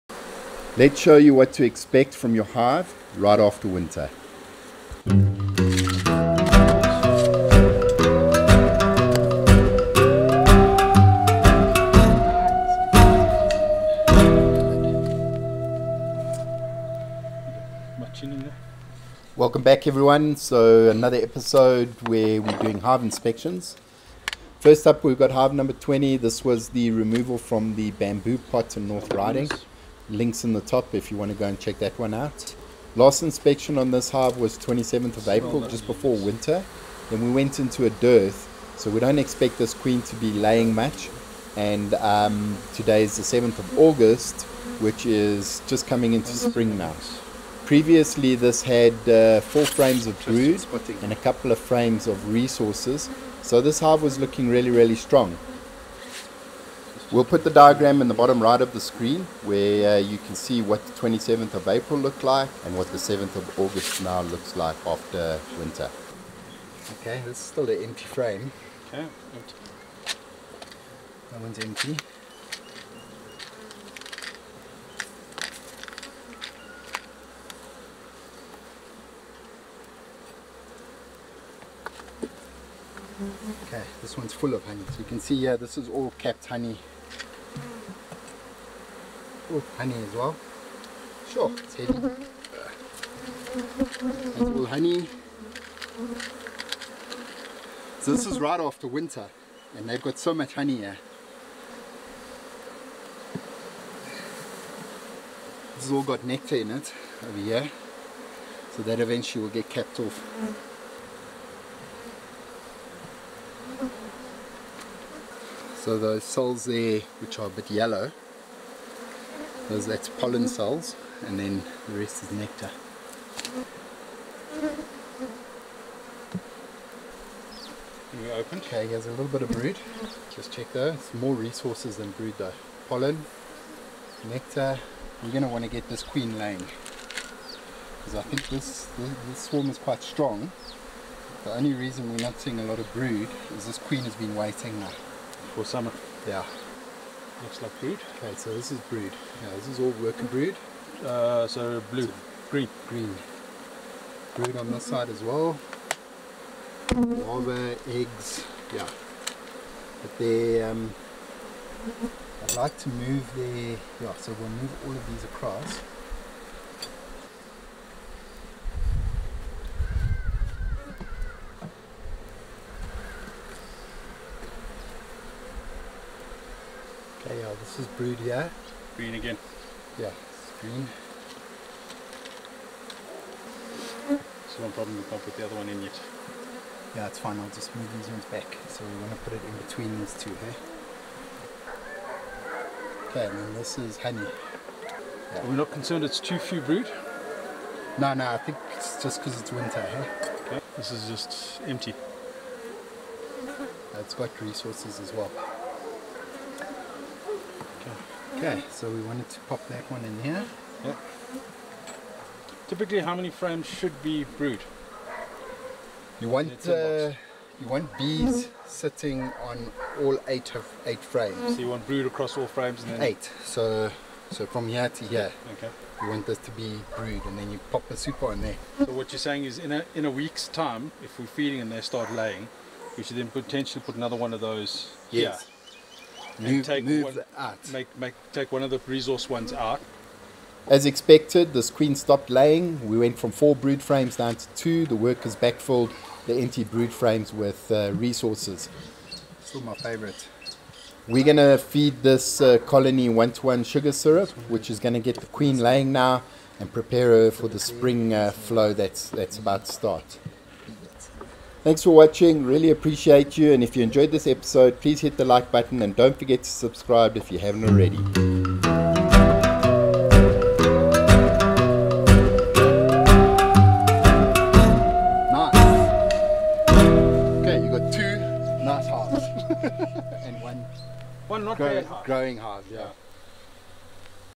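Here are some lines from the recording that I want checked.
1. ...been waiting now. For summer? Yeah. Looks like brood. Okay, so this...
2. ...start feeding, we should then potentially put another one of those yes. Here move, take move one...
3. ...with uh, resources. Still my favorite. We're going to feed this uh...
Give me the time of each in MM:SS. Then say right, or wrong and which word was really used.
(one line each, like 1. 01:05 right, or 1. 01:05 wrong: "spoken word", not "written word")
1. 02:24 right
2. 03:51 wrong: "laying", not "feeding"
3. 04:07 right.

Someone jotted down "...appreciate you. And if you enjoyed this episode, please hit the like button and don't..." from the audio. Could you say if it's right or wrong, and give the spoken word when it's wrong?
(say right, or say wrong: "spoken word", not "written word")
right.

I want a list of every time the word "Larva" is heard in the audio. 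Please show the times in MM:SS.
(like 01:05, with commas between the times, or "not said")
02:36.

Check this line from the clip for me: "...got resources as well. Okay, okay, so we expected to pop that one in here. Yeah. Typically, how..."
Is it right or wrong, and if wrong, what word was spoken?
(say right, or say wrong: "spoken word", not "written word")
wrong: "wanted", not "expected".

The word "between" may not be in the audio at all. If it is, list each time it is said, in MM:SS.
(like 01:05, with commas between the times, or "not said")
03:09.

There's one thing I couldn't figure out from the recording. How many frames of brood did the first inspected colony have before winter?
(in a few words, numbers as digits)
4.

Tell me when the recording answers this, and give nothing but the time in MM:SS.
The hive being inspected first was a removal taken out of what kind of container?
00:27.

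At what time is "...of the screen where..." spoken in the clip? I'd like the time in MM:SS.
00:58.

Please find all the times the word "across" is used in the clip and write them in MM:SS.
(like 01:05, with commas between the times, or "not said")
02:45, 03:42.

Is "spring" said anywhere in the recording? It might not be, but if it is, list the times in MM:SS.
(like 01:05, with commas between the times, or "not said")
00:46, 04:17.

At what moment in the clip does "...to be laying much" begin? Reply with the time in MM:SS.
00:40.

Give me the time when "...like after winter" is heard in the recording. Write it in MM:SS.
01:04.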